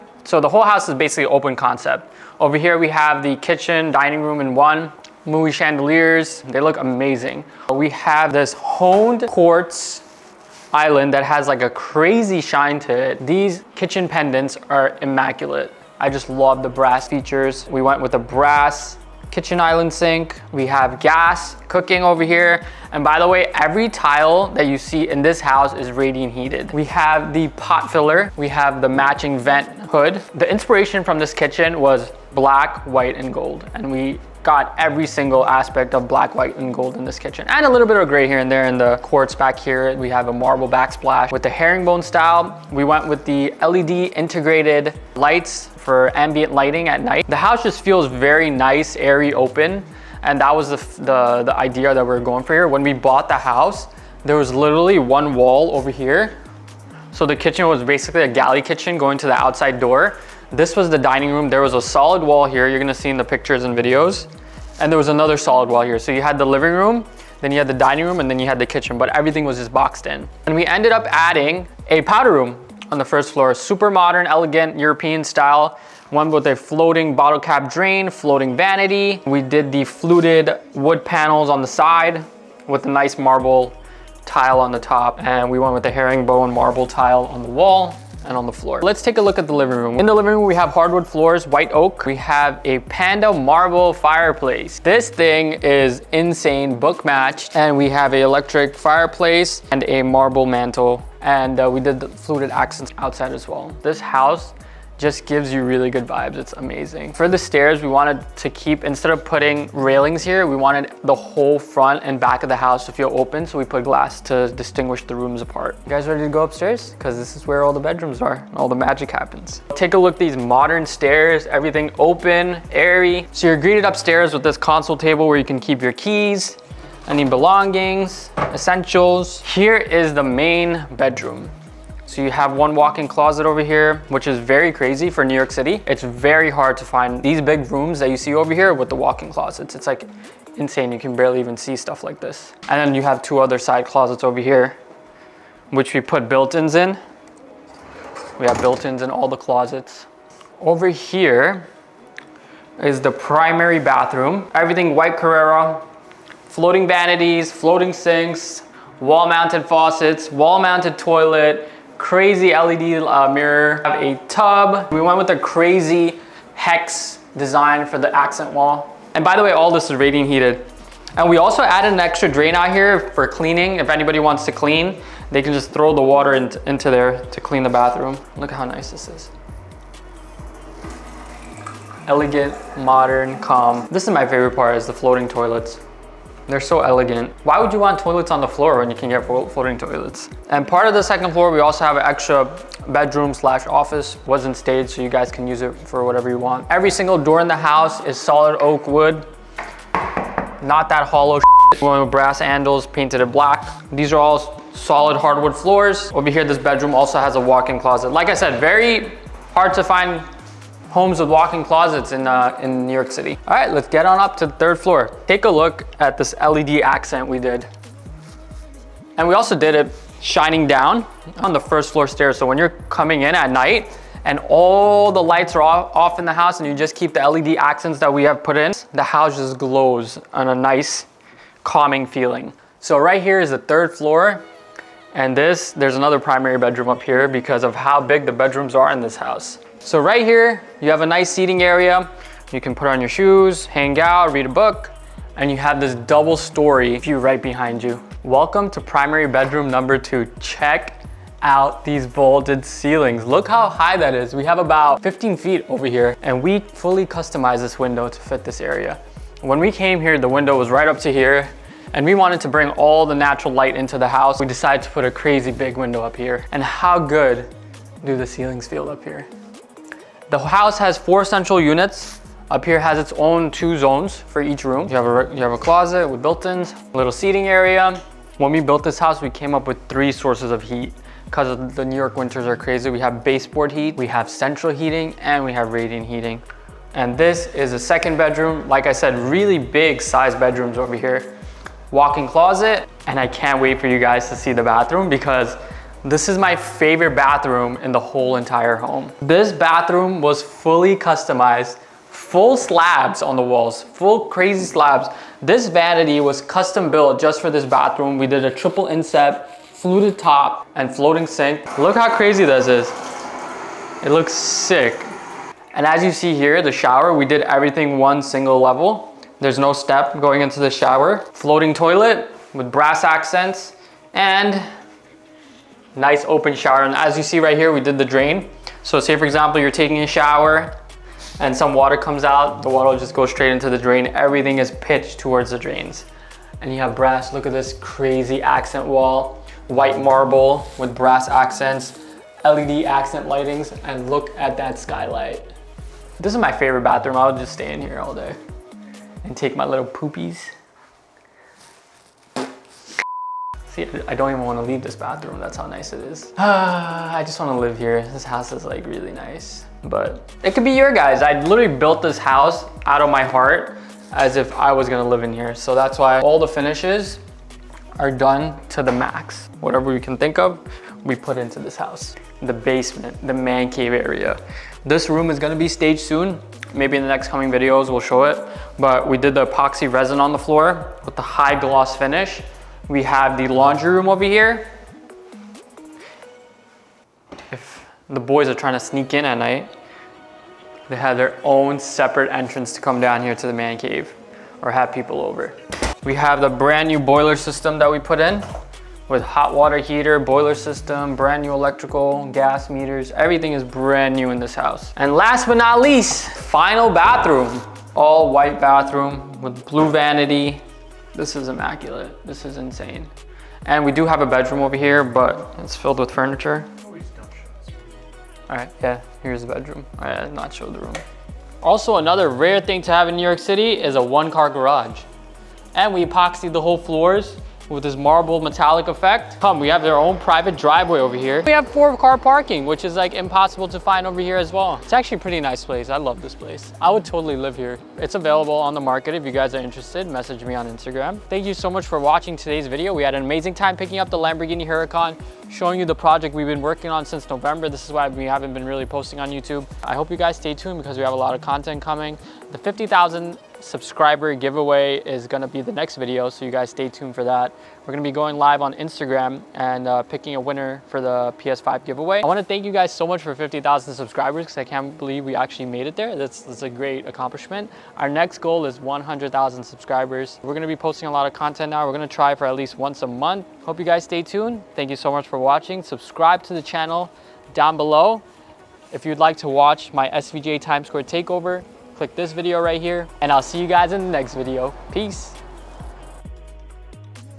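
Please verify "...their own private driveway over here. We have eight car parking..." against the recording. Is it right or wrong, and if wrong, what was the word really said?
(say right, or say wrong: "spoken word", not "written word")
wrong: "four", not "eight".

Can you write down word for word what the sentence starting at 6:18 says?
But we did the epoxy resin on the floor with the high gloss finish.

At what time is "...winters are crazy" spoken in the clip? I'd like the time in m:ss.
4:42.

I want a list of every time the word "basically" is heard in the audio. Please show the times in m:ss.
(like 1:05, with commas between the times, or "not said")
0:00, 0:57.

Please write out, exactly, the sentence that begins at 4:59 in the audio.
This bathroom was fully customized, full slabs on the walls, full crazy slabs.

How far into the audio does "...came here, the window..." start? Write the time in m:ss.
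4:19.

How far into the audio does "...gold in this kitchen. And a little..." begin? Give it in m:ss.
0:36.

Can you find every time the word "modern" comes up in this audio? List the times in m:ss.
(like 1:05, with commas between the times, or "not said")
1:13, 2:00, 3:02.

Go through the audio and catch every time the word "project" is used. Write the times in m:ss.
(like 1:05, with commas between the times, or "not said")
7:25.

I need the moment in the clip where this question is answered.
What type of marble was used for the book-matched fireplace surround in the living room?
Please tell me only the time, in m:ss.
1:32.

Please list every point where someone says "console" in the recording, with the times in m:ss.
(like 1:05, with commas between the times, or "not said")
2:04.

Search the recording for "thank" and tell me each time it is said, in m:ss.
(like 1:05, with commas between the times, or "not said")
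7:21, 7:42, 7:54.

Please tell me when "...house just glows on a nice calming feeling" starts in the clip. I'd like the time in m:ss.
3:49.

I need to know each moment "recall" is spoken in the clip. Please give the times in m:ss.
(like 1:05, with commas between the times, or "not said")
not said.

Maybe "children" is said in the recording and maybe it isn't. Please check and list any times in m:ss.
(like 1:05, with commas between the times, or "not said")
not said.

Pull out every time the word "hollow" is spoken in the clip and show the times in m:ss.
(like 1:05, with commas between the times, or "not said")
3:21.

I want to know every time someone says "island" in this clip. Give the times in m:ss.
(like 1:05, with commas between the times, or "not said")
0:10, 0:19.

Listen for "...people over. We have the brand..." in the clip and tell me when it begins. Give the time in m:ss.
6:34.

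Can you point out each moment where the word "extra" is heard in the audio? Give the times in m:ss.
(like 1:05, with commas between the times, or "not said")
2:51, 3:12.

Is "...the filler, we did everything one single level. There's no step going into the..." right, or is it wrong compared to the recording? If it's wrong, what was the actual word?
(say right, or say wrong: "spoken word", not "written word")
wrong: "shower", not "filler".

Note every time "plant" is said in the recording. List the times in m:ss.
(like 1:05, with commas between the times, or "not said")
not said.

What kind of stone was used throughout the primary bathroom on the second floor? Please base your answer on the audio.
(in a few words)
White Carrara.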